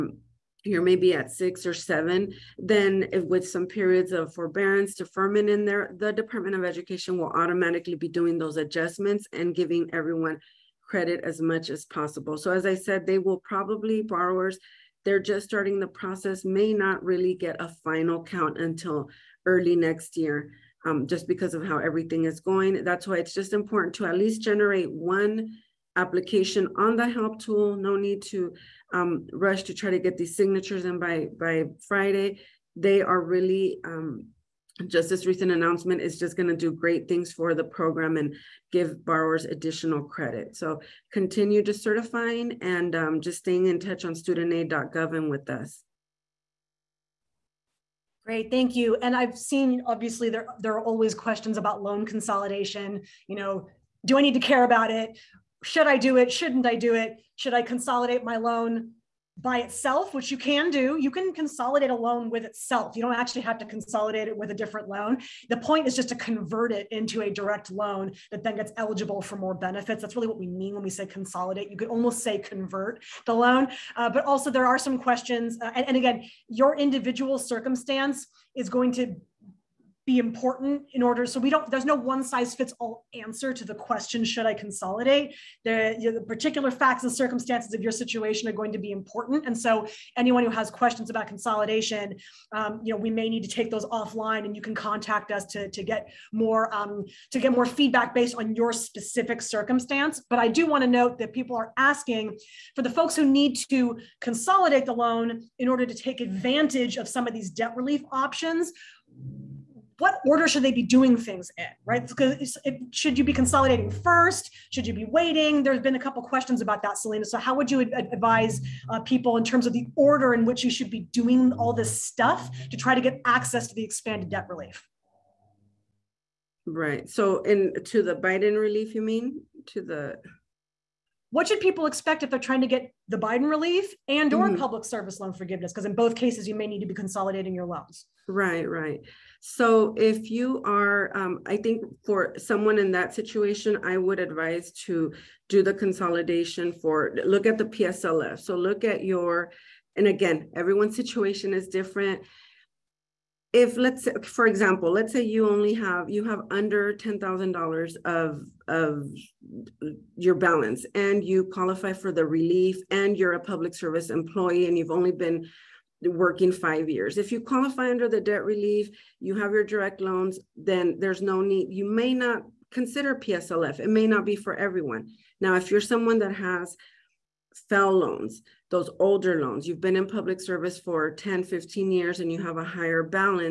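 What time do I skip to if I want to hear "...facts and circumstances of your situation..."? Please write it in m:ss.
1:26.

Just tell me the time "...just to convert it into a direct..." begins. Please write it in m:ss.
1:05.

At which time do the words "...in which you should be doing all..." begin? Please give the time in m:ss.
2:00.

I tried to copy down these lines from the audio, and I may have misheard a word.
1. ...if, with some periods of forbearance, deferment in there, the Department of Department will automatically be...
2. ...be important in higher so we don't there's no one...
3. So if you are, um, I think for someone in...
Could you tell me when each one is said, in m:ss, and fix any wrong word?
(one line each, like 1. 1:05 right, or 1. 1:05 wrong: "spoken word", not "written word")
1. 0:03 wrong: "Education", not "Department"
2. 1:20 wrong: "order", not "higher"
3. 2:19 right.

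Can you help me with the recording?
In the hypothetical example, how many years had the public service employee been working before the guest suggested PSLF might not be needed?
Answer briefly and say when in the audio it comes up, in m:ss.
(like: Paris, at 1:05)
5 years, at 2:46.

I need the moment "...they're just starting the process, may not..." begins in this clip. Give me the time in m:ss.
0:15.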